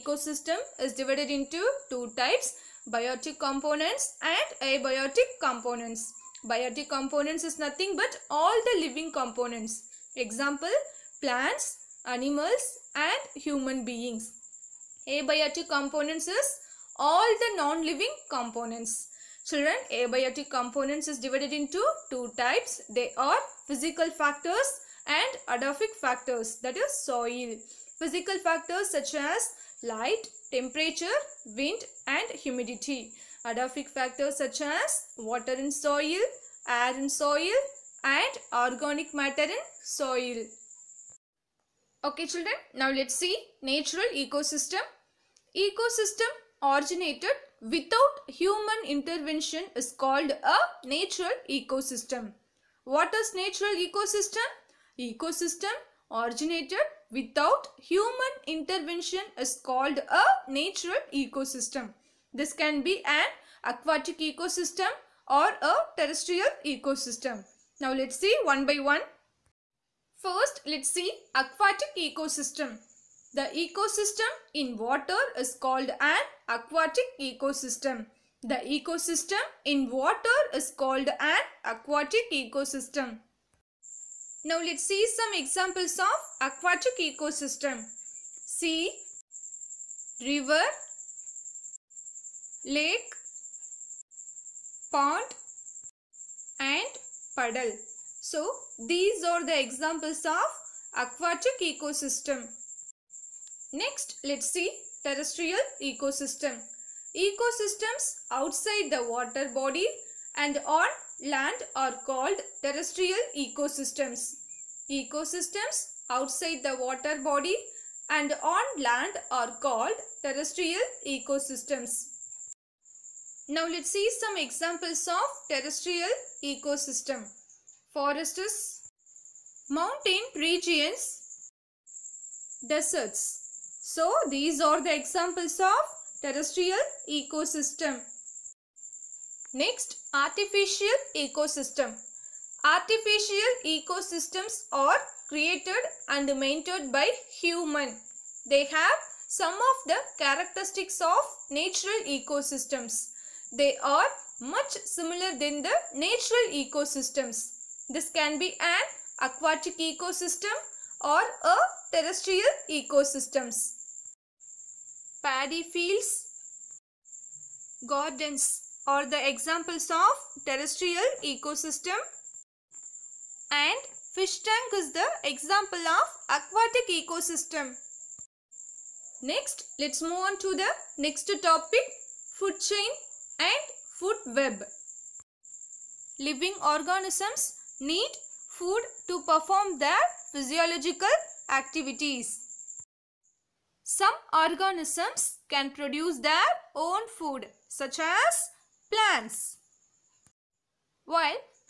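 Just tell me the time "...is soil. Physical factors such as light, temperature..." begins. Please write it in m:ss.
0:26.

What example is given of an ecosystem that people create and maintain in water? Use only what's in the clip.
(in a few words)
Fish tank.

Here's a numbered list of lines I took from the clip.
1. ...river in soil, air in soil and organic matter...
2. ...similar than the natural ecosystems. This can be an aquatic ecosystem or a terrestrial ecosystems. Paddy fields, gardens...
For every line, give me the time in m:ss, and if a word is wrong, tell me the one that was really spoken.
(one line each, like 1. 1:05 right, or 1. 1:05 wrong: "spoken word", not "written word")
1. 0:35 wrong: "water", not "river"
2. 2:34 right.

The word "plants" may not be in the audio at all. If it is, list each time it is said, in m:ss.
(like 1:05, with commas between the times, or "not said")
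0:11, 3:18.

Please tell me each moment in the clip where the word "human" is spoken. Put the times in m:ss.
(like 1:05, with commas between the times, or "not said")
0:13, 0:48, 0:57, 2:27.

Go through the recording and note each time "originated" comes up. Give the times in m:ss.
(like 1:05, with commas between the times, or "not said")
0:46, 0:56.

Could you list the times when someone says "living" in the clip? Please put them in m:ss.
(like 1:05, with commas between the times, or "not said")
0:08, 0:17, 3:06.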